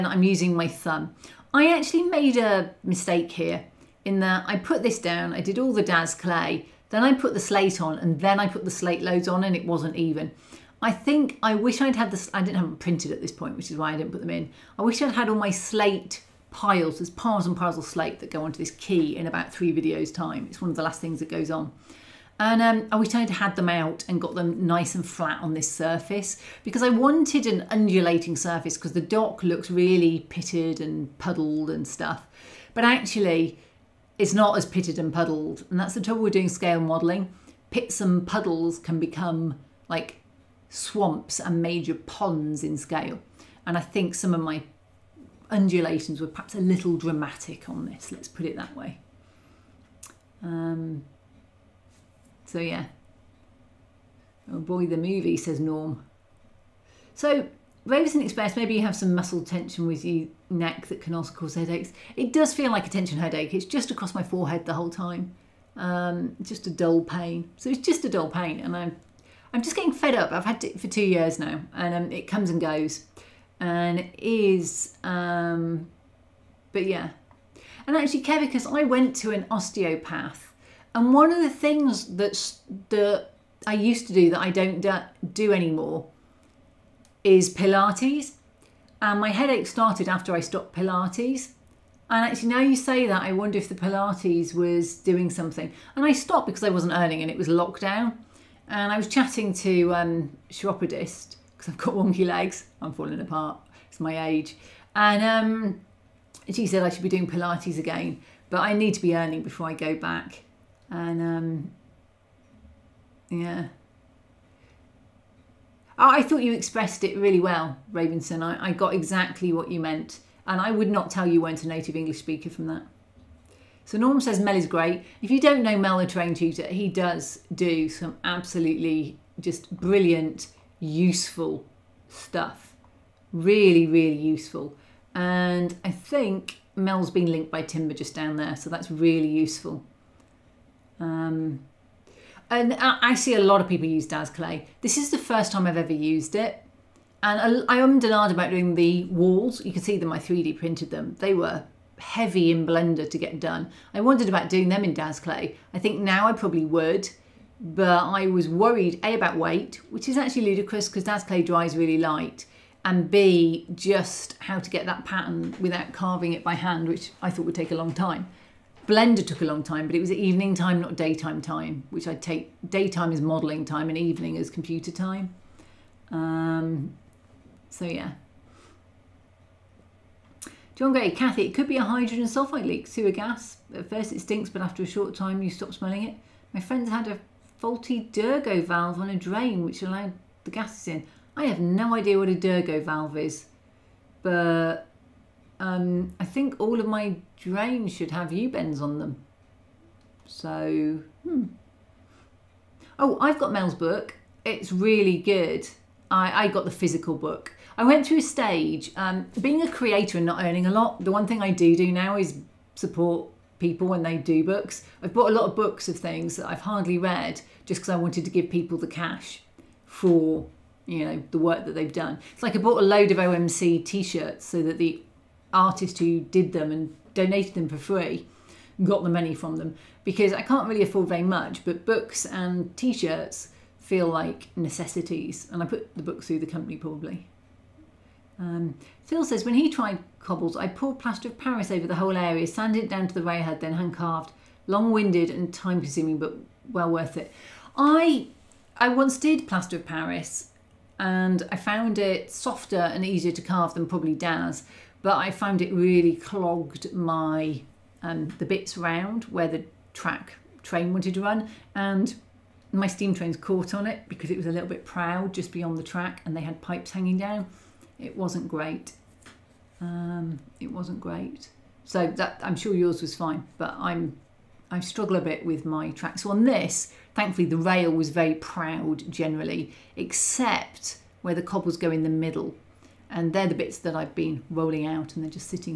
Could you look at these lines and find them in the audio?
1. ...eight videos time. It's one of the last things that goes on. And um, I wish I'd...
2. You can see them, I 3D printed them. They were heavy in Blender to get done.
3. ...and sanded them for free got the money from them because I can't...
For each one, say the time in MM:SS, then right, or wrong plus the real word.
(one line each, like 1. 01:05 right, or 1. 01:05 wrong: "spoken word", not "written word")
1. 00:19 wrong: "three", not "eight"
2. 02:29 right
3. 03:46 wrong: "donated", not "sanded".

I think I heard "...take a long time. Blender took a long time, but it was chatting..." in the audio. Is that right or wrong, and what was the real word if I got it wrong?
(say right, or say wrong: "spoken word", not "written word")
wrong: "evening", not "chatting".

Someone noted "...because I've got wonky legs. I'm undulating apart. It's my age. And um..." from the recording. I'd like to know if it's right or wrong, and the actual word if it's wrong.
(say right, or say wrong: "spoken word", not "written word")
wrong: "falling", not "undulating".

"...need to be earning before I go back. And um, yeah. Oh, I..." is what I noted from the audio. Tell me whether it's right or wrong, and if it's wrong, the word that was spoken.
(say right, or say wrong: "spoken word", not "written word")
right.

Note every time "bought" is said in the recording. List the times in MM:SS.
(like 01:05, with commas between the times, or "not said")
03:35, 03:42.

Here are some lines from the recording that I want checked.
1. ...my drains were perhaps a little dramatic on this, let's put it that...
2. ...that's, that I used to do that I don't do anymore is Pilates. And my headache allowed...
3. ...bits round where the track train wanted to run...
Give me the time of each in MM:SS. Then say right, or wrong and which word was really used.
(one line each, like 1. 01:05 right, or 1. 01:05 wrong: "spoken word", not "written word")
1. 00:44 wrong: "undulations", not "drains"
2. 01:22 wrong: "started", not "allowed"
3. 04:18 right.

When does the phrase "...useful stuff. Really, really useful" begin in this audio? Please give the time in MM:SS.
02:10.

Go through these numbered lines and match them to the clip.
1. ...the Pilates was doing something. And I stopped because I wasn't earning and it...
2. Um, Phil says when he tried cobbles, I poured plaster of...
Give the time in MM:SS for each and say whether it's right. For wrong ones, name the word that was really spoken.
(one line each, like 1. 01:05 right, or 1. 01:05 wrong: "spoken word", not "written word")
1. 01:33 right
2. 03:58 right.